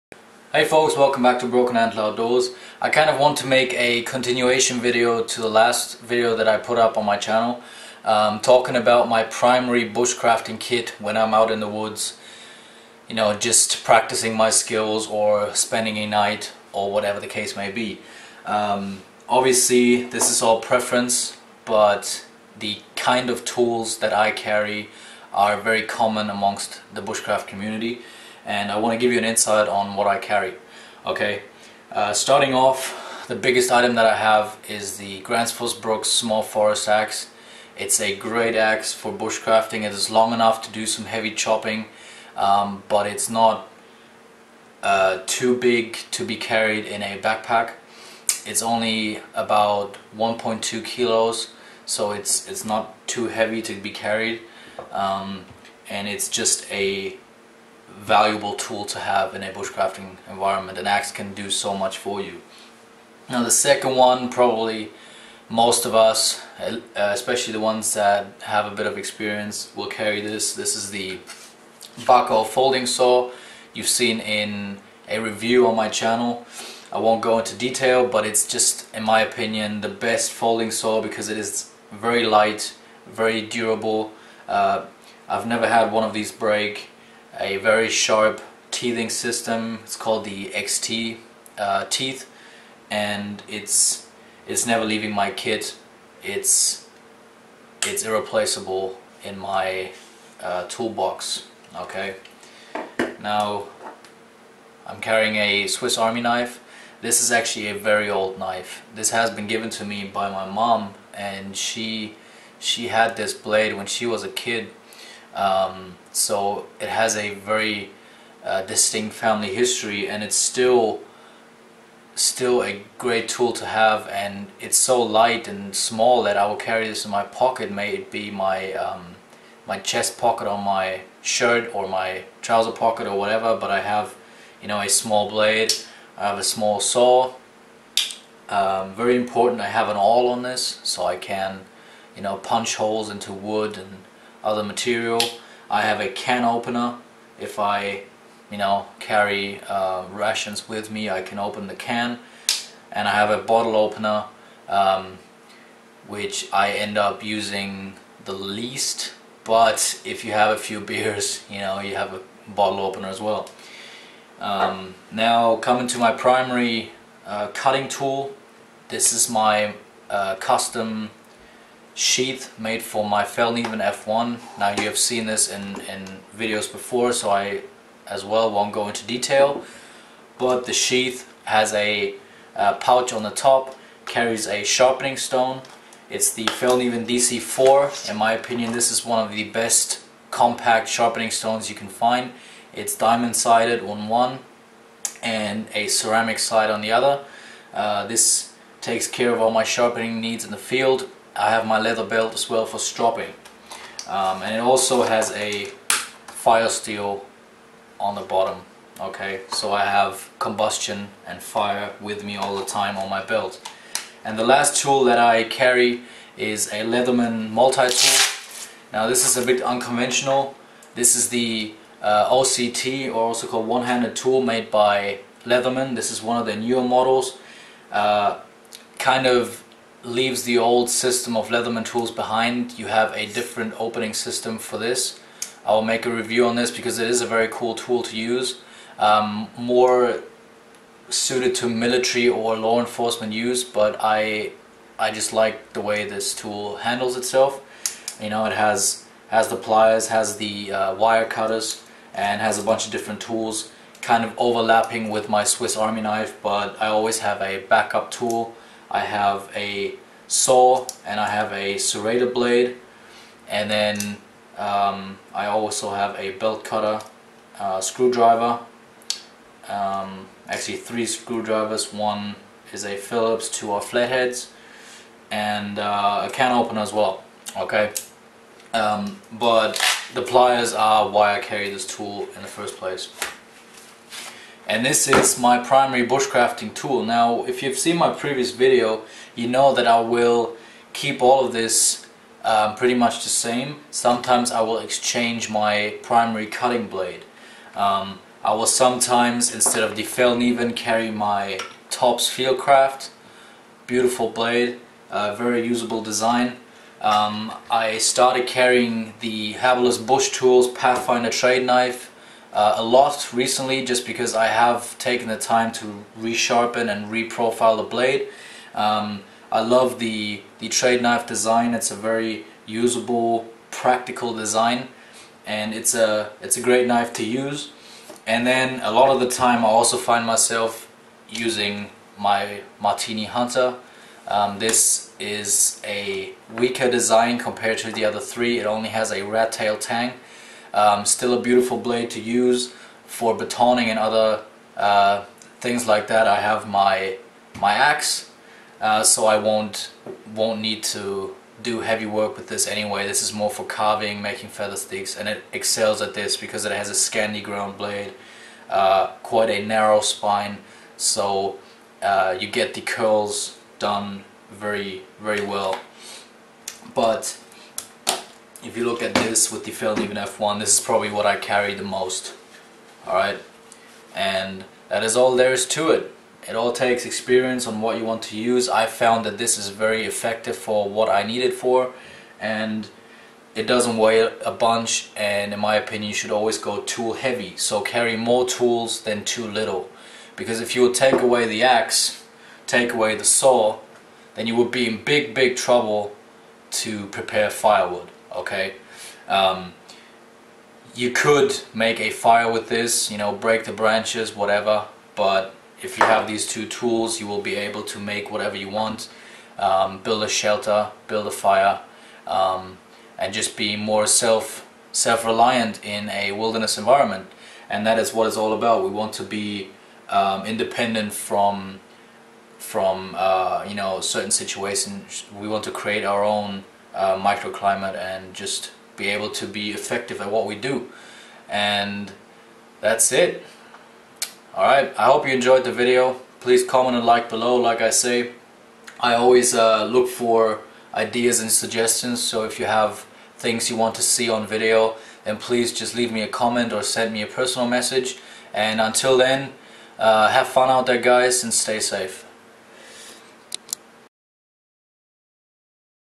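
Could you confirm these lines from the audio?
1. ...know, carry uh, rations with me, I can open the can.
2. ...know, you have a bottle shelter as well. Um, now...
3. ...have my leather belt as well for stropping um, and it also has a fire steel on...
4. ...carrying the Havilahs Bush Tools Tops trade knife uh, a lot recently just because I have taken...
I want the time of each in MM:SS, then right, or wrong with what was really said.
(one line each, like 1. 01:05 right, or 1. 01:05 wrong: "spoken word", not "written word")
1. 02:28 right
2. 02:41 wrong: "opener", not "shelter"
3. 03:21 right
4. 05:08 wrong: "Pathfinder", not "Tops".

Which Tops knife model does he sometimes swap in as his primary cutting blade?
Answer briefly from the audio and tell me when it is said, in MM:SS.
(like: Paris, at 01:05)
Tops Fieldcraft, at 05:01.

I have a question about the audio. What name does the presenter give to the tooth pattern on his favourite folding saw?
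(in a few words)
XT.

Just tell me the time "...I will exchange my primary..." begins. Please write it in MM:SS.
04:54.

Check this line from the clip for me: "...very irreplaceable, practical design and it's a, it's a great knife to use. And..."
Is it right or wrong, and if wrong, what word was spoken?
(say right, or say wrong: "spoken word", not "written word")
wrong: "usable", not "irreplaceable".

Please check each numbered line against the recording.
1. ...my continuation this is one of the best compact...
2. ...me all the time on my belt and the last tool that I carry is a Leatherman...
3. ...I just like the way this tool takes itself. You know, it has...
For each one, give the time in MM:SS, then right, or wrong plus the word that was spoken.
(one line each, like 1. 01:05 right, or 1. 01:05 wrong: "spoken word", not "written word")
1. 03:08 wrong: "opinion", not "continuation"
2. 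03:32 right
3. 04:04 wrong: "handles", not "takes".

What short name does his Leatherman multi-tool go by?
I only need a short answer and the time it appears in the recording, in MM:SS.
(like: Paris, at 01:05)
OHT, at 03:42.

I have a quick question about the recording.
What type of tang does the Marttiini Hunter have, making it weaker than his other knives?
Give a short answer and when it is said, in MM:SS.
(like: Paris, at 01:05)
rat tail tang, at 05:39.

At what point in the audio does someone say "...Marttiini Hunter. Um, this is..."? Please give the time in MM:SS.
05:32.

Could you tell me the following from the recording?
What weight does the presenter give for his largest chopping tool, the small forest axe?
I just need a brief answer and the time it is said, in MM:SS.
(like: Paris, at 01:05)
1.2 kilos, at 00:50.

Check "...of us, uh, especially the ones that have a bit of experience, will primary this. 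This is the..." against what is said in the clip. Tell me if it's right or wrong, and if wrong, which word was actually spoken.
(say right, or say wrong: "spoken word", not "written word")
wrong: "carry", not "primary".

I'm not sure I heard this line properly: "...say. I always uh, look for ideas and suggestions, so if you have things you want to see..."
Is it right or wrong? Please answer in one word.
right.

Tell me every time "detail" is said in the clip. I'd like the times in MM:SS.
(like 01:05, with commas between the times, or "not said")
01:17, 02:59.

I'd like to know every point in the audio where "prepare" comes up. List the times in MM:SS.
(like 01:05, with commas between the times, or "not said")
06:37.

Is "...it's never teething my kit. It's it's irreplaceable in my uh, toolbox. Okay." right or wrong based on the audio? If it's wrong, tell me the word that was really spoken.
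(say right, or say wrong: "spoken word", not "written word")
wrong: "leaving", not "teething".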